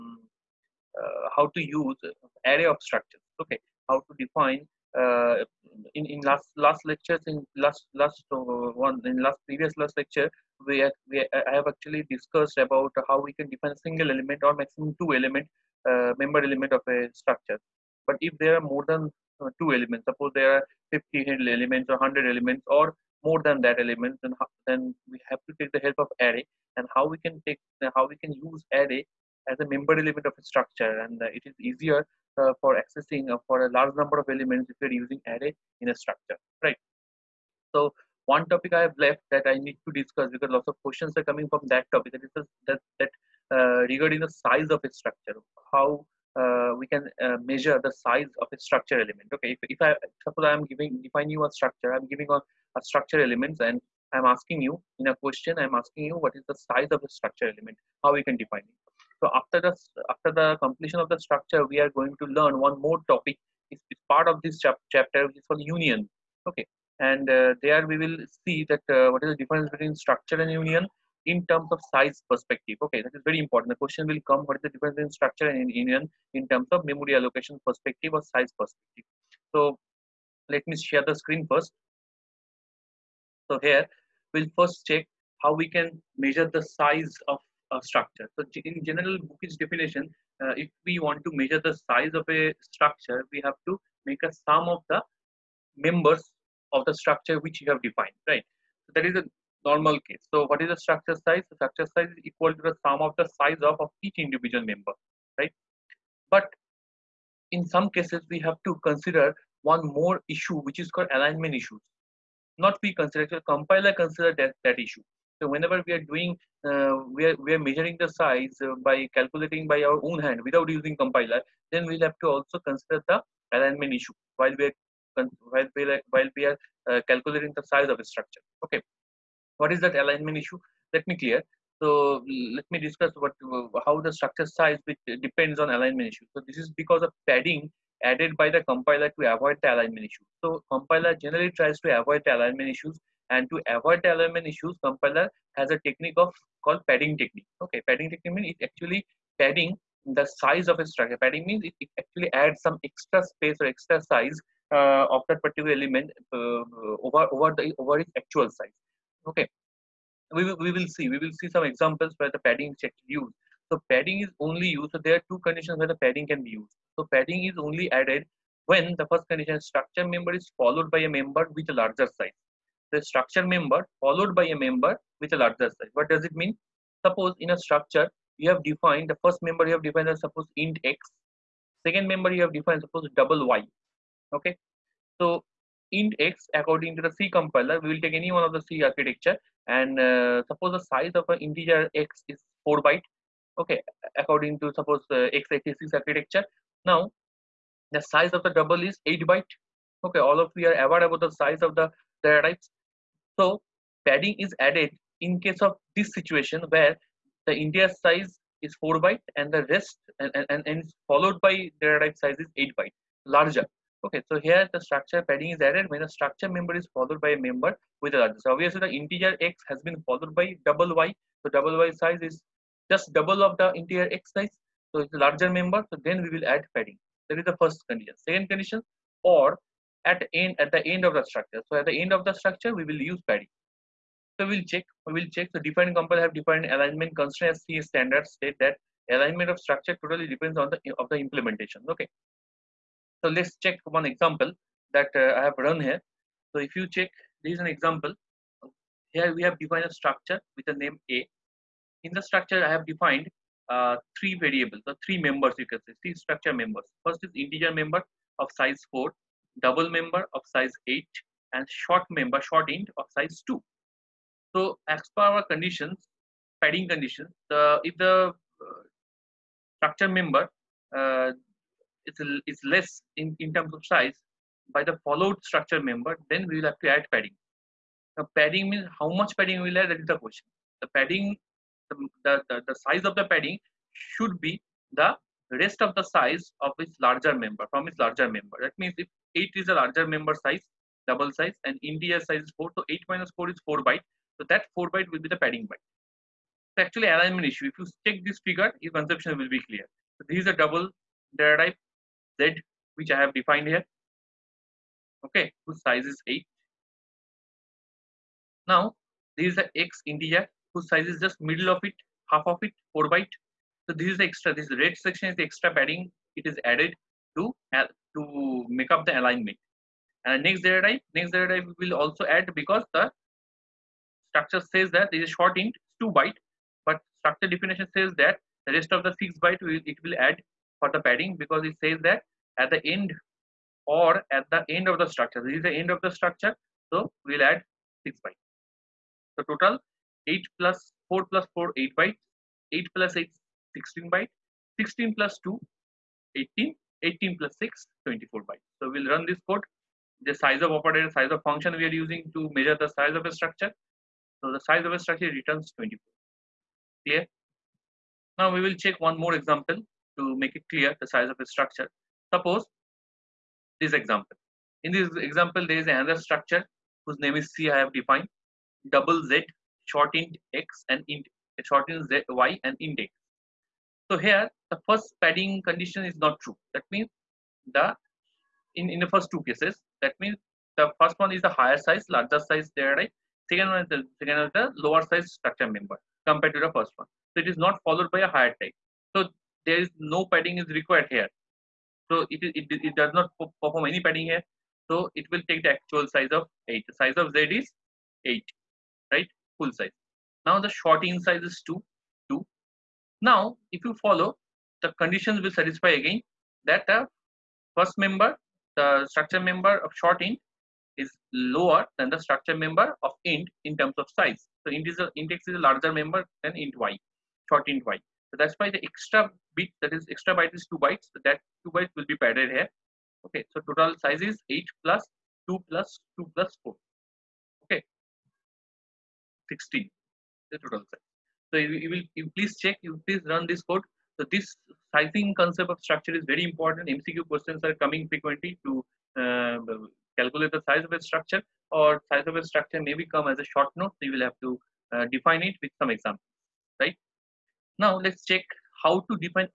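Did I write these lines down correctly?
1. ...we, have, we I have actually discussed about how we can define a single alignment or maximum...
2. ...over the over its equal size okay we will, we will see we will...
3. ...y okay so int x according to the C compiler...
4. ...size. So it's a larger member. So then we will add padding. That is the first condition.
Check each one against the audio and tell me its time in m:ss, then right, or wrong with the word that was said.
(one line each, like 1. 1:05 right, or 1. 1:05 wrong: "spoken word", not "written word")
1. 0:10 wrong: "element", not "alignment"
2. 2:37 wrong: "actual", not "equal"
3. 3:03 right
4. 3:44 right.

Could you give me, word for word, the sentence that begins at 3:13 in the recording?
Okay, according to suppose uh, x86 architecture.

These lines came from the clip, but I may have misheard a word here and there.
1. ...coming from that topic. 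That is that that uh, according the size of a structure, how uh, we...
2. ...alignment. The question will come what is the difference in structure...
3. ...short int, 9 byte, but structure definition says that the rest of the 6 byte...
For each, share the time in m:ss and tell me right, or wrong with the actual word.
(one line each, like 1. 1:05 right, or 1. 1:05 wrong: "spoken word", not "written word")
1. 0:41 wrong: "regarding", not "according"
2. 1:13 wrong: "important", not "alignment"
3. 5:25 wrong: "2", not "9".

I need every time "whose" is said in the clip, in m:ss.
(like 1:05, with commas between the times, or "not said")
5:05, 5:10, 6:07.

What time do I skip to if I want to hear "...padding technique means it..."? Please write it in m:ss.
2:27.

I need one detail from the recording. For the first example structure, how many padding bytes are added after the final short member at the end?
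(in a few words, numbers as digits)
6.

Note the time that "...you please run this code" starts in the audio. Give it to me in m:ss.
7:12.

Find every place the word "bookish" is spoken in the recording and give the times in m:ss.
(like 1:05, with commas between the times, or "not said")
1:29.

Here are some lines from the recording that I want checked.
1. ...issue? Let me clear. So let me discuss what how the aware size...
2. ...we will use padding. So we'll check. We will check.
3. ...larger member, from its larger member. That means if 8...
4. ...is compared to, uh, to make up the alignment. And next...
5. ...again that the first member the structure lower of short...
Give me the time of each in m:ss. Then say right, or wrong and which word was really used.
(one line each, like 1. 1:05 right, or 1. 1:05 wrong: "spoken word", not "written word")
1. 2:10 wrong: "structure", not "aware"
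2. 3:52 right
3. 4:47 right
4. 5:16 wrong: "added", not "compared"
5. 6:46 wrong: "member", not "lower".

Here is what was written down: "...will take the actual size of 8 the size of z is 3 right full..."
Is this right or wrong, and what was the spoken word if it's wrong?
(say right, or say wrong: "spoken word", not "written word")
wrong: "8", not "3".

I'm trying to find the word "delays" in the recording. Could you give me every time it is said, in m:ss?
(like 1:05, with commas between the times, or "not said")
not said.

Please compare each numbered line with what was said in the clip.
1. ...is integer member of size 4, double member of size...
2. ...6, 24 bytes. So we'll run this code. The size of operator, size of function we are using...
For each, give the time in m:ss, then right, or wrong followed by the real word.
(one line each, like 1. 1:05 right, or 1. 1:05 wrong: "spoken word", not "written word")
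1. 4:17 right
2. 5:47 right.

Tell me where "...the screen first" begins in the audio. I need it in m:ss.
1:21.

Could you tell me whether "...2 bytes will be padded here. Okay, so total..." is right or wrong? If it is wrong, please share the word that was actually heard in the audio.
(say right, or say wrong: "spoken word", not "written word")
right.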